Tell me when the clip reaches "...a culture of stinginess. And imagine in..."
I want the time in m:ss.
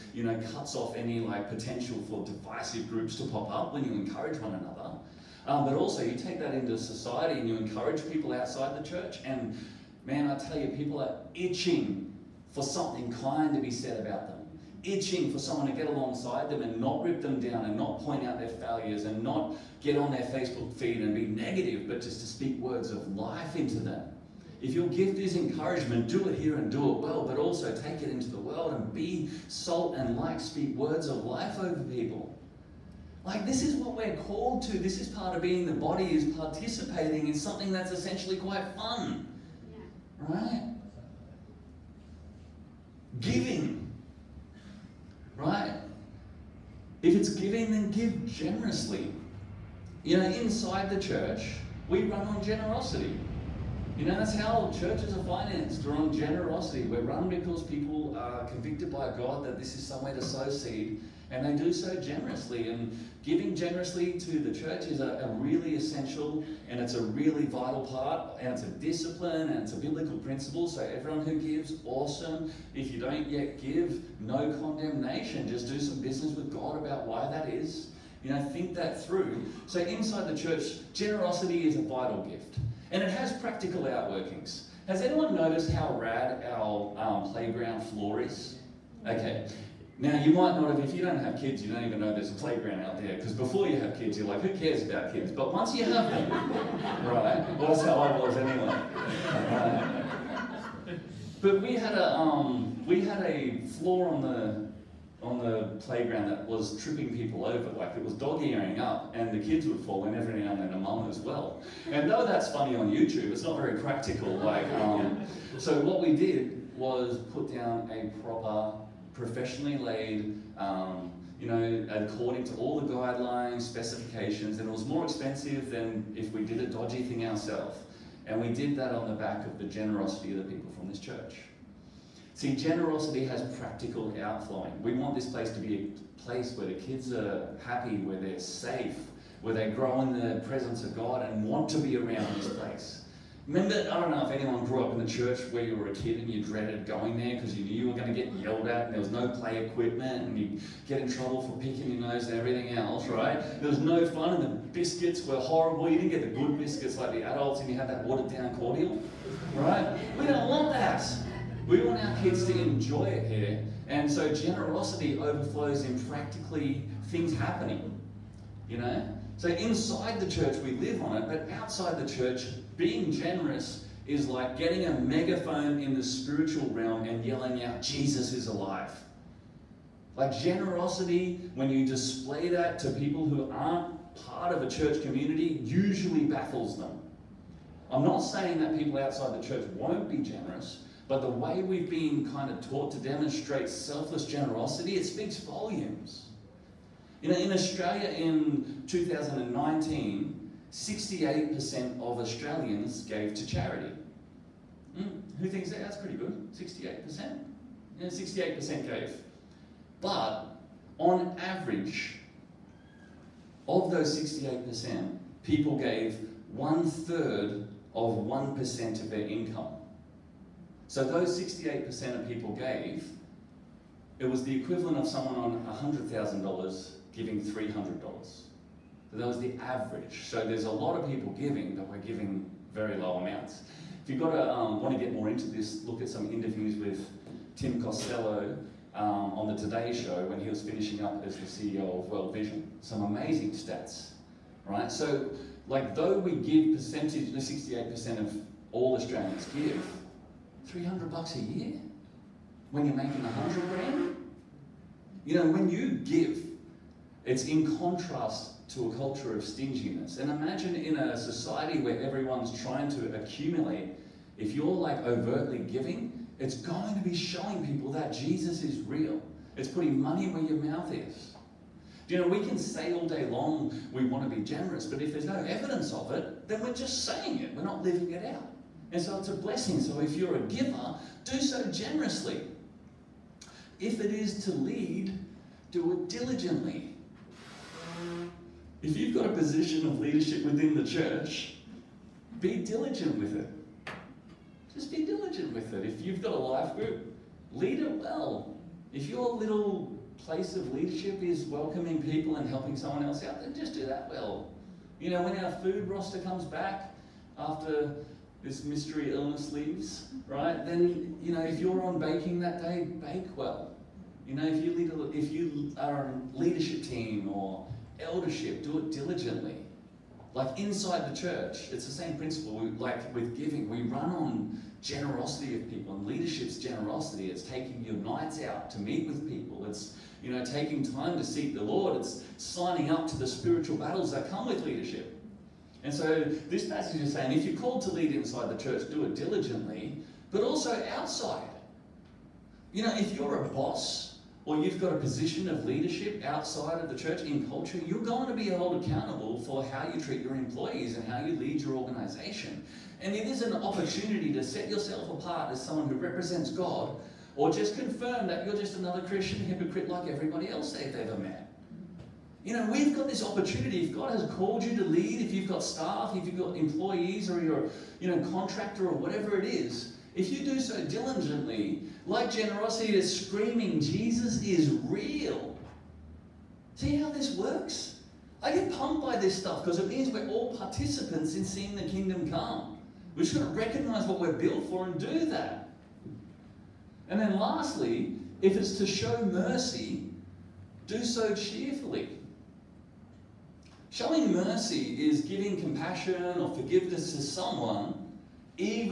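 4:18.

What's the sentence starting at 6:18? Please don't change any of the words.
I get pumped by this stuff because it means we're all participants in seeing the kingdom come.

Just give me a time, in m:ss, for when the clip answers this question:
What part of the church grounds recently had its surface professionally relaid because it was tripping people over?
1:27.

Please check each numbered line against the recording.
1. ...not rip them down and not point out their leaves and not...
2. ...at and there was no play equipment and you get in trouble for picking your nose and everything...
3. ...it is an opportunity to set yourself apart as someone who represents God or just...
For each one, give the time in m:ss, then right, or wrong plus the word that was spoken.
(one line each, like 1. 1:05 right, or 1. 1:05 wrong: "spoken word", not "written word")
1. 0:16 wrong: "failures", not "leaves"
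2. 2:28 right
3. 5:53 right.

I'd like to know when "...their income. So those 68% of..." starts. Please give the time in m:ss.
3:39.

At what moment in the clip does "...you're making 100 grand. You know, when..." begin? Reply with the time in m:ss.
4:12.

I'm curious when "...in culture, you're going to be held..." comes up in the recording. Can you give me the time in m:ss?
5:47.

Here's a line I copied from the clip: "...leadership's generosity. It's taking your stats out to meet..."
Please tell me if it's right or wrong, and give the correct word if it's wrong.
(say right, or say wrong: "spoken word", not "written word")
wrong: "nights", not "stats".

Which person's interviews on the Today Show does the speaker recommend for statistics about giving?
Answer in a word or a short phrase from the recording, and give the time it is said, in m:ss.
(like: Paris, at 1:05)
Tim Costello, at 3:57.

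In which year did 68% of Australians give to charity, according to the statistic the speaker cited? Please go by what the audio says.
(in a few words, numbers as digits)
2019.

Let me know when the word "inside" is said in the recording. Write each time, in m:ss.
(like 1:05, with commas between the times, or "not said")
0:50, 1:19, 2:49, 5:20, 5:38.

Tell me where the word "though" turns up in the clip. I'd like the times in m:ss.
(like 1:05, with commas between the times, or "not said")
1:52, 4:05.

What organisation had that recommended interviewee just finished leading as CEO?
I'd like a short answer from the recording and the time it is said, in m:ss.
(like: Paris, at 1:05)
World Vision, at 4:02.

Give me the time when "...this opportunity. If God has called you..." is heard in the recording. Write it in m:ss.
6:03.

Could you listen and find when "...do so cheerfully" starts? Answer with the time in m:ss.
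6:30.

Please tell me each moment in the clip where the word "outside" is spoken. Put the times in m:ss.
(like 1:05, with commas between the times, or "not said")
0:08, 2:51, 3:08, 5:40, 5:46.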